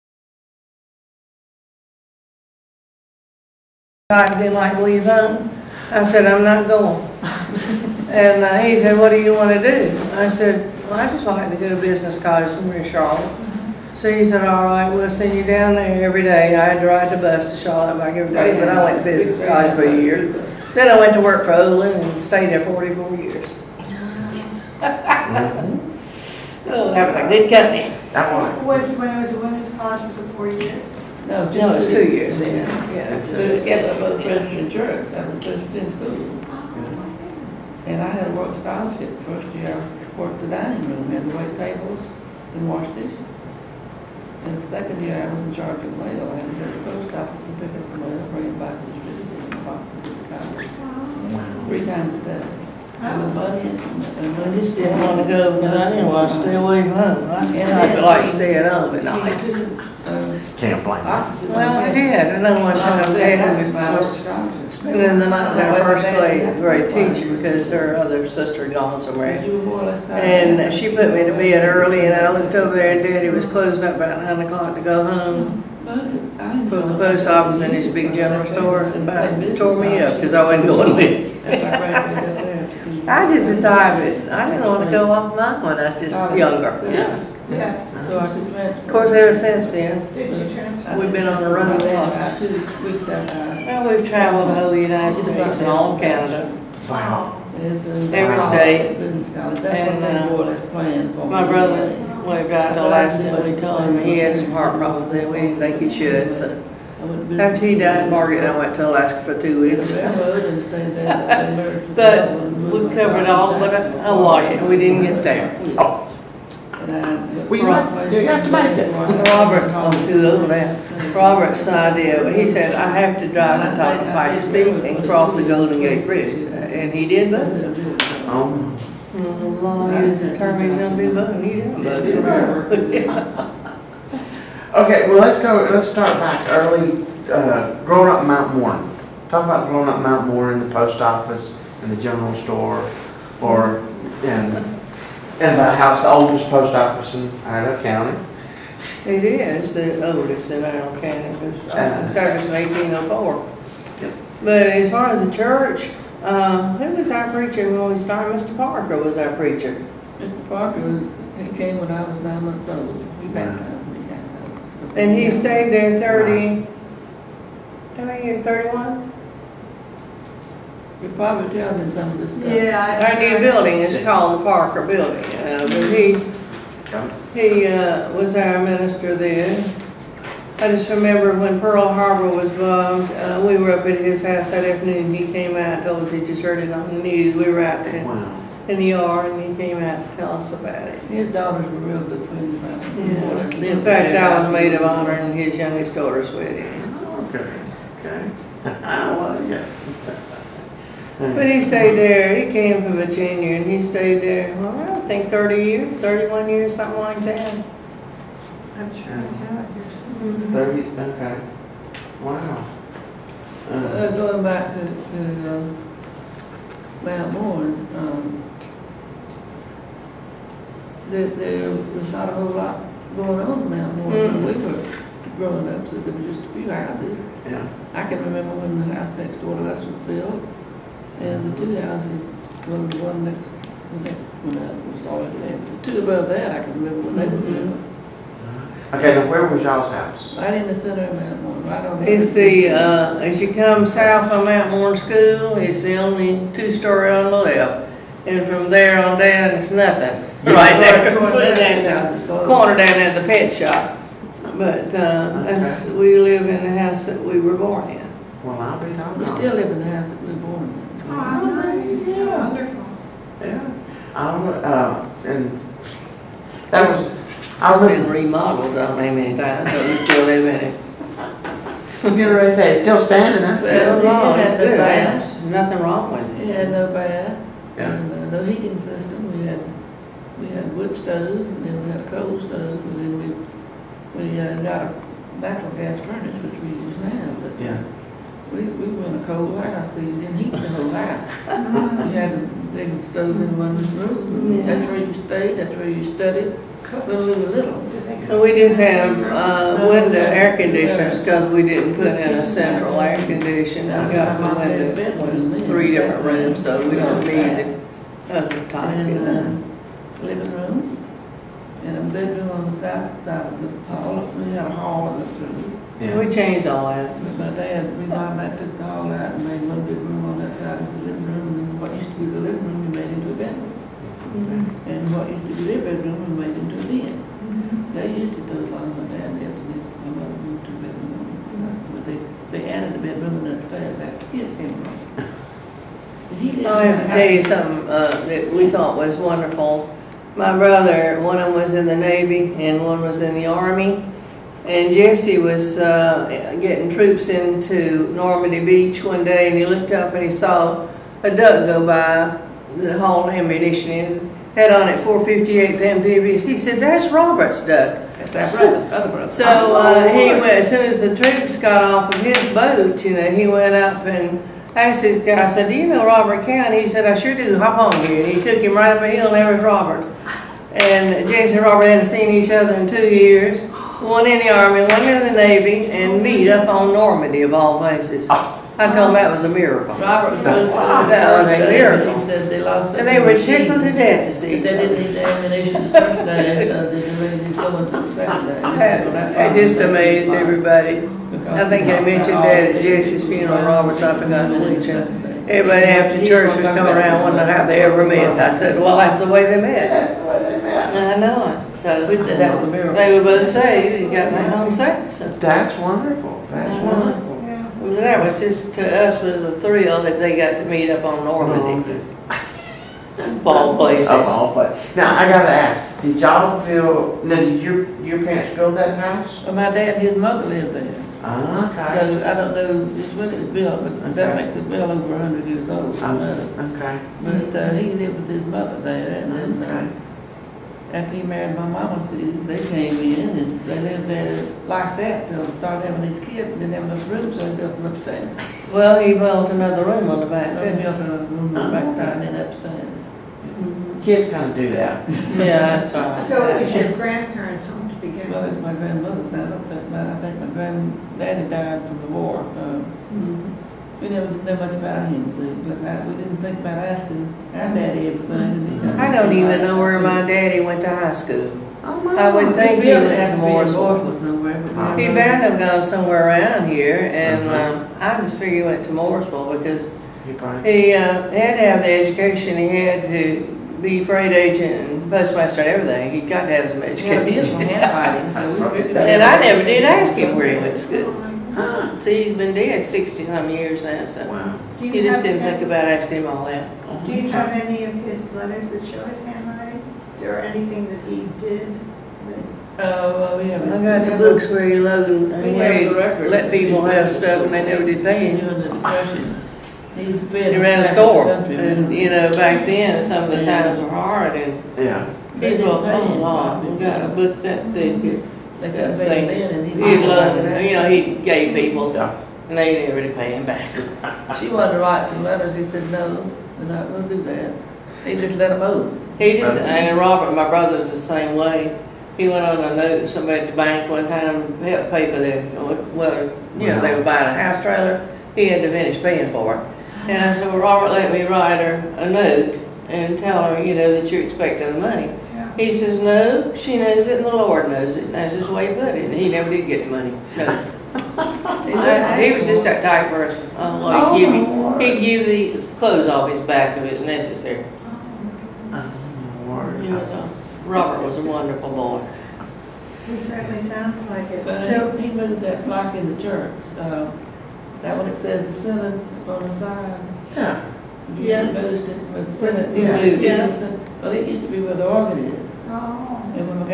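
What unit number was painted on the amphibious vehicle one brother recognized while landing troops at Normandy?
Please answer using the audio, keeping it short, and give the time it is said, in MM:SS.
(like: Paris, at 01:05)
458th, at 05:54.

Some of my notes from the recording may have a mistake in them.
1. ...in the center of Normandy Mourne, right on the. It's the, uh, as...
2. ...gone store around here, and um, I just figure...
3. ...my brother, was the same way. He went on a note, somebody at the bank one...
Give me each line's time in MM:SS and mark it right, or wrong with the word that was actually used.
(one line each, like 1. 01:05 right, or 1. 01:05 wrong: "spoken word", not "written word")
1. 04:00 wrong: "Mount", not "Normandy"
2. 07:45 wrong: "somewhere", not "store"
3. 08:40 right.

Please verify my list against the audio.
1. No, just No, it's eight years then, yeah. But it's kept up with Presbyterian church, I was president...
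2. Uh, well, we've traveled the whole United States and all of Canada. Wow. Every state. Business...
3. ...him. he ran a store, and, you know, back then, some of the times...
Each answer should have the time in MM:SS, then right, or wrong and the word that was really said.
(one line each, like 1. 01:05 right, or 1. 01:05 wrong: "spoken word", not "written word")
1. 00:31 wrong: "two", not "eight"
2. 01:32 right
3. 08:18 right.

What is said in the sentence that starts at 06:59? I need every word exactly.
Well, my dad and his mother lived there.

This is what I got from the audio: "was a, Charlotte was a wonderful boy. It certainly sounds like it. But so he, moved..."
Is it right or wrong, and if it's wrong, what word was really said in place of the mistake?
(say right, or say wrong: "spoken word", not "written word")
wrong: "Robert", not "Charlotte".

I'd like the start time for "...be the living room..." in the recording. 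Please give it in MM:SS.
05:22.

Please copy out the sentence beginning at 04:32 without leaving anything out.
I'm getting ready to say it's still standing.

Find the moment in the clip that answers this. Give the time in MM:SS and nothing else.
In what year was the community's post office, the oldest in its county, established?
02:32.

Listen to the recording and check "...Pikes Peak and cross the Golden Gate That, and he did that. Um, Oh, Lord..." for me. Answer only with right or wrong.
wrong.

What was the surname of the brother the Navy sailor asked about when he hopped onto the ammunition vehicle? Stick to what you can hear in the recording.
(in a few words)
Cowan.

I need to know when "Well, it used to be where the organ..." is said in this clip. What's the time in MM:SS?
09:24.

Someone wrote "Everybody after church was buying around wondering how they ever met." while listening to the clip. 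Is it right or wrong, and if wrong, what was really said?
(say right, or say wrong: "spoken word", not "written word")
wrong: "coming", not "buying".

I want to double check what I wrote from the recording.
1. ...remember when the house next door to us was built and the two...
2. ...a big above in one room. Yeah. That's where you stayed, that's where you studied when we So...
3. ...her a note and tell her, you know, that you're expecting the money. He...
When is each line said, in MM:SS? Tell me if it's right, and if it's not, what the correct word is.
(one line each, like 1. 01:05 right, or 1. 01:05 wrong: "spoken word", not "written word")
1. 03:48 right
2. 04:52 wrong: "stove", not "above"
3. 08:51 right.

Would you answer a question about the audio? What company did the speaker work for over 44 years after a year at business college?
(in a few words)
Olin.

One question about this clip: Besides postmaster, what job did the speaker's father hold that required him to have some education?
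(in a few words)
Freight agent.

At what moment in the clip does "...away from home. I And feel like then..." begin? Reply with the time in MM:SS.
00:56.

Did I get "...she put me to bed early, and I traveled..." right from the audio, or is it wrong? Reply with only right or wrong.
wrong.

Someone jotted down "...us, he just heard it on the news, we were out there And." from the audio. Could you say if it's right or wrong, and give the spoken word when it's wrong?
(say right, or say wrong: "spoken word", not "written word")
wrong: "Wow", not "And".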